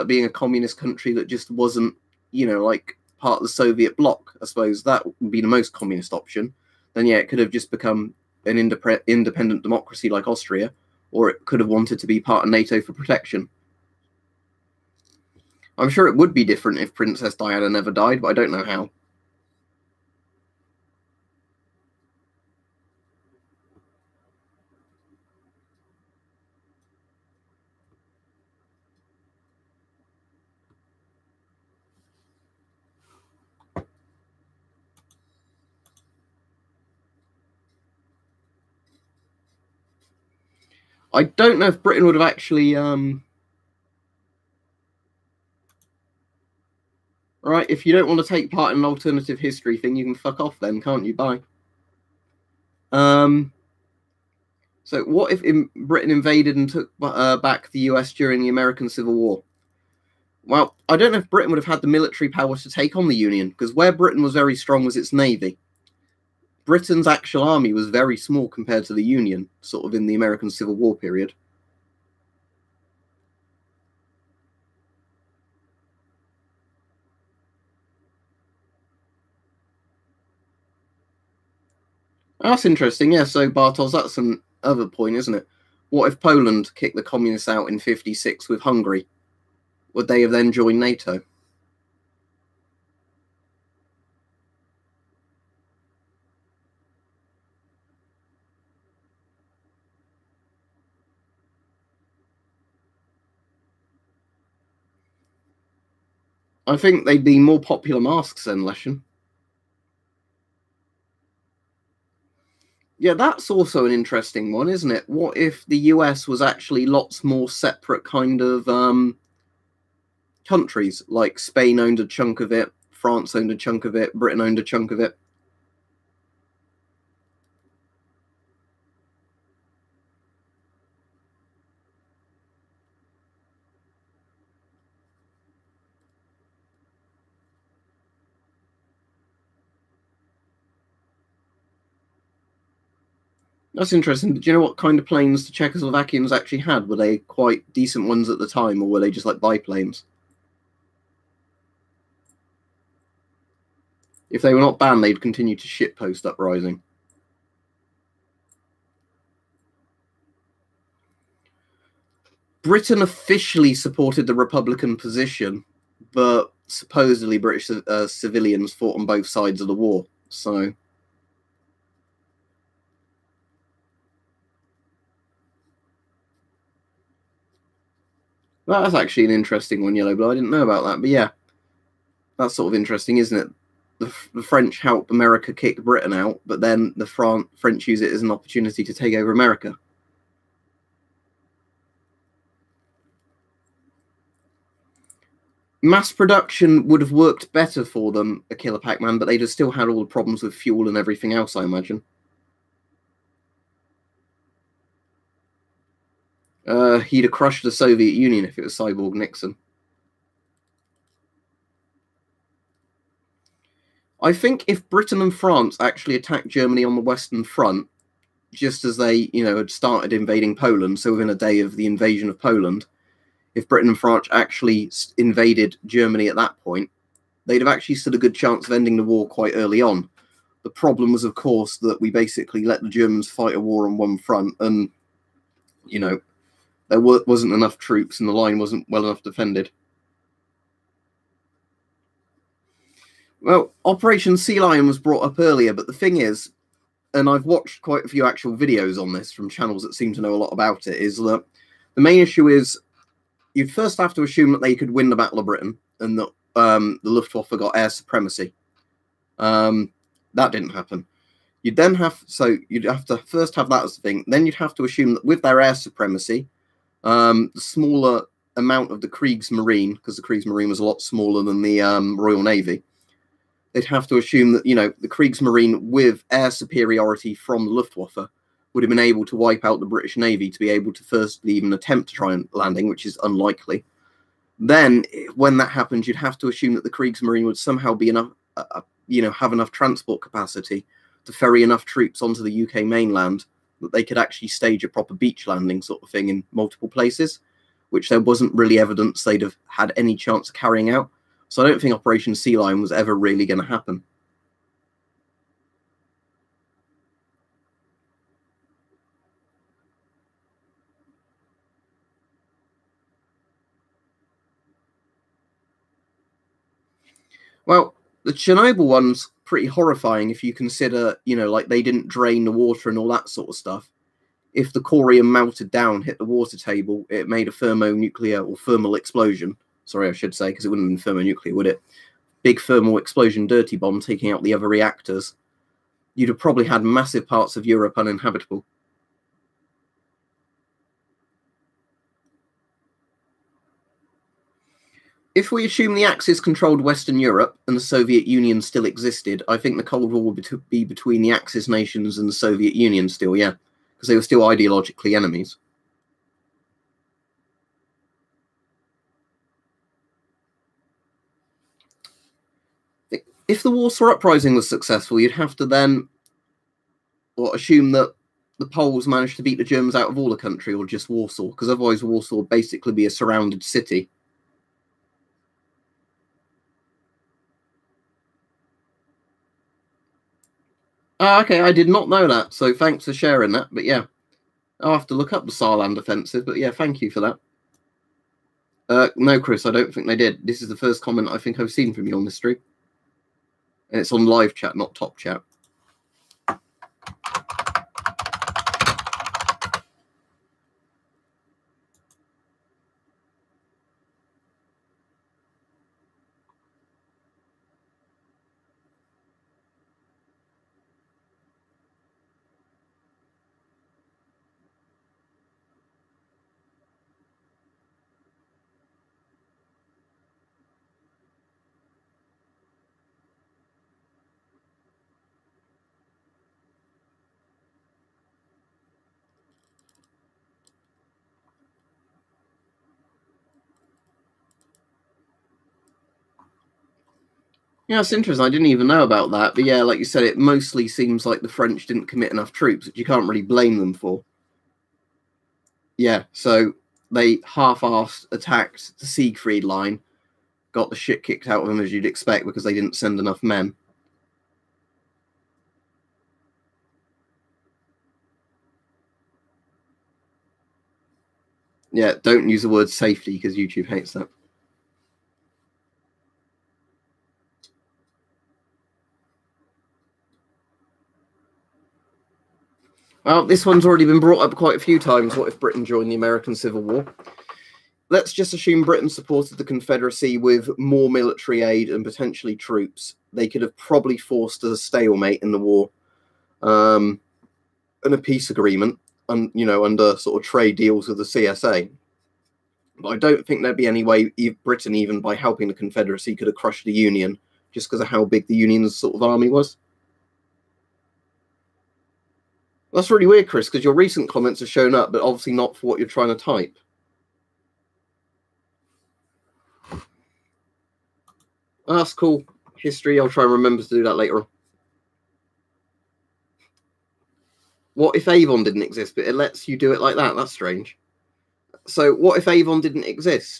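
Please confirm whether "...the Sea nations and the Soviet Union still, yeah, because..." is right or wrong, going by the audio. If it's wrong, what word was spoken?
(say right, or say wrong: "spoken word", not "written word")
wrong: "Axis", not "Sea".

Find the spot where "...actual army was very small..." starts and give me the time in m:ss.
1:07.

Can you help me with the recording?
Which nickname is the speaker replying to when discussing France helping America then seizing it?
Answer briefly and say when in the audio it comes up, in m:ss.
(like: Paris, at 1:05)
Yellow Blood, at 2:59.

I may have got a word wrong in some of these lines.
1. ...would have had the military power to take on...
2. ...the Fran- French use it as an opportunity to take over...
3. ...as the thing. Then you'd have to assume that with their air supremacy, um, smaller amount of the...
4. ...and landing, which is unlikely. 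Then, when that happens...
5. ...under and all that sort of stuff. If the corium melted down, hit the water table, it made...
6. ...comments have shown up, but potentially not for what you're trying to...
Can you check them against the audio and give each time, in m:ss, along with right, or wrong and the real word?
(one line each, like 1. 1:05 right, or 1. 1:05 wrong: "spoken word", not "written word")
1. 1:01 right
2. 3:06 right
3. 4:23 right
4. 4:42 right
5. 5:22 wrong: "water", not "under"
6. 8:24 wrong: "obviously", not "potentially".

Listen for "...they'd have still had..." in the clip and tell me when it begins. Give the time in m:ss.
3:19.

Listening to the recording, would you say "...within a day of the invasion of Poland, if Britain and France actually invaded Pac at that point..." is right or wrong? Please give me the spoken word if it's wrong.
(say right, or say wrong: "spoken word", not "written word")
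wrong: "Germany", not "Pac".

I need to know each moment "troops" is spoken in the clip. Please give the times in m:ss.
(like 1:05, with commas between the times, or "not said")
3:57, 4:51, 7:22, 8:02.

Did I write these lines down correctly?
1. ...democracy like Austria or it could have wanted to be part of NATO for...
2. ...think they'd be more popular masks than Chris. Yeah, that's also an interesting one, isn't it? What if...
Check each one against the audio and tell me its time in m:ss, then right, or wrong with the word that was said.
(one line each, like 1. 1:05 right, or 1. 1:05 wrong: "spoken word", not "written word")
1. 0:09 right
2. 1:46 wrong: "Leshen", not "Chris".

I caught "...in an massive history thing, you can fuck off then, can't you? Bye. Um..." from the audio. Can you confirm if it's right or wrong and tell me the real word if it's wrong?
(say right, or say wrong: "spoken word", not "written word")
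wrong: "alternative", not "massive".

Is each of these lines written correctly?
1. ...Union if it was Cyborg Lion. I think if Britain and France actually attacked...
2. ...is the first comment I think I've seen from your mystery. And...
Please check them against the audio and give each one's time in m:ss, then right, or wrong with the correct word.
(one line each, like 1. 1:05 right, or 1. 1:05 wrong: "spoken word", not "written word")
1. 3:28 wrong: "Nixon", not "Lion"
2. 6:30 right.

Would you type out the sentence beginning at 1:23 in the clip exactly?
So, Bartos, that's an other point, isn't it?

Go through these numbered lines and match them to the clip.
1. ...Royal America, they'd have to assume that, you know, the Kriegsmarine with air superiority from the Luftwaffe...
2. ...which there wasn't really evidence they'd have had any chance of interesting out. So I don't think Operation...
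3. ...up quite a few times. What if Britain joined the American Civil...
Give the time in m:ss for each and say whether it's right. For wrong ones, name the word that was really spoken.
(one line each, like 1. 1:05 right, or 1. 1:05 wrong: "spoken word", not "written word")
1. 4:32 wrong: "Navy", not "America"
2. 4:57 wrong: "carrying", not "interesting"
3. 7:54 right.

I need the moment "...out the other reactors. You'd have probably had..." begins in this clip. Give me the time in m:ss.
5:34.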